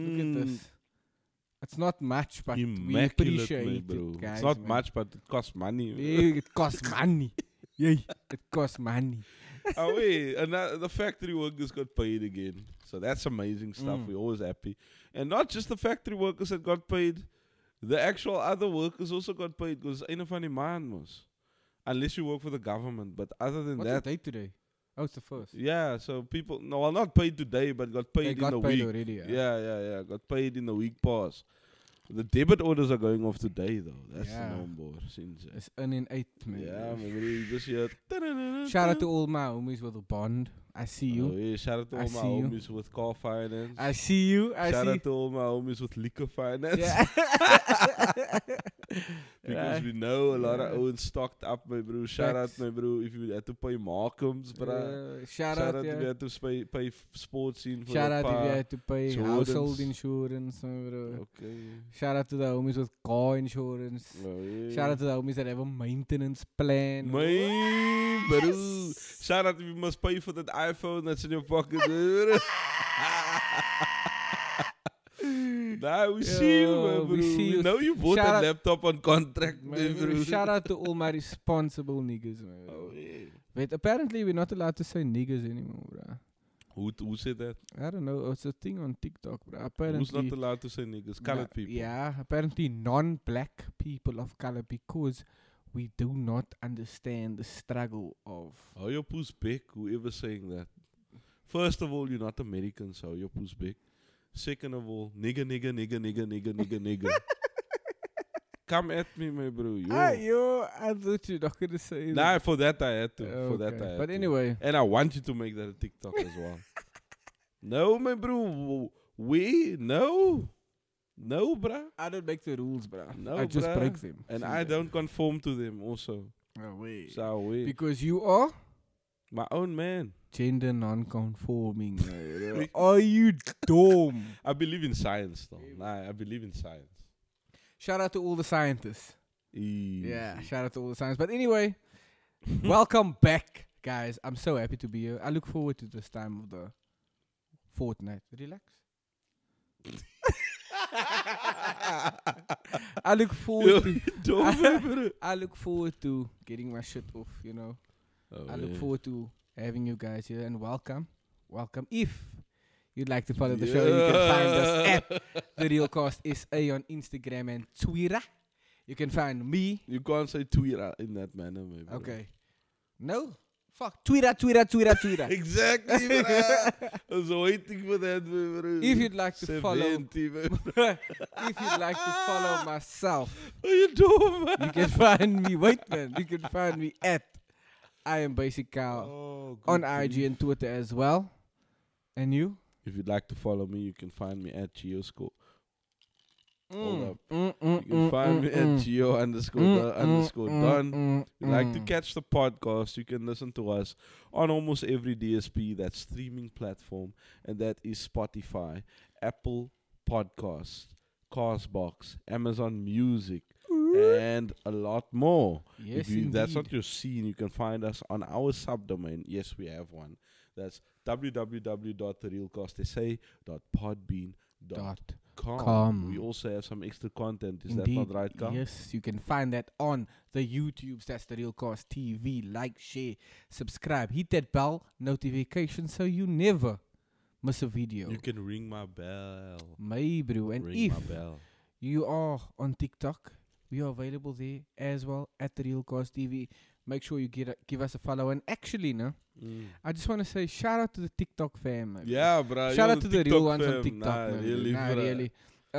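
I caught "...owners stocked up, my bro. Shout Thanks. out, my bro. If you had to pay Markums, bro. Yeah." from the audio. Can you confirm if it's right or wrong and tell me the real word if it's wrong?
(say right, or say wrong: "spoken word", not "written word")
right.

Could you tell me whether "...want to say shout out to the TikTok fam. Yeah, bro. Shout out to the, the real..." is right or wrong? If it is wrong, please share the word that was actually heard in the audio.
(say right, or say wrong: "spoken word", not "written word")
right.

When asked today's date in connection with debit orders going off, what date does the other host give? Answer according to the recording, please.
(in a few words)
the first.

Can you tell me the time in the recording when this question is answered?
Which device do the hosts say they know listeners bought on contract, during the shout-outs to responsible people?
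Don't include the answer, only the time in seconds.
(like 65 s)
78 s.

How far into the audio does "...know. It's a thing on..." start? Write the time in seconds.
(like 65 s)
88 s.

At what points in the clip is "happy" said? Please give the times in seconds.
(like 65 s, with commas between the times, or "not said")
14 s, 144 s.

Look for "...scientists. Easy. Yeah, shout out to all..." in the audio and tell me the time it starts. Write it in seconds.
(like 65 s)
138 s.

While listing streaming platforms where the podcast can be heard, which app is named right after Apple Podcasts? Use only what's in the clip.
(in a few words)
Castbox.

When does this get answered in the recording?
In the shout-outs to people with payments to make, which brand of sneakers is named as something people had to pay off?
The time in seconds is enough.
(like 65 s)
59 s.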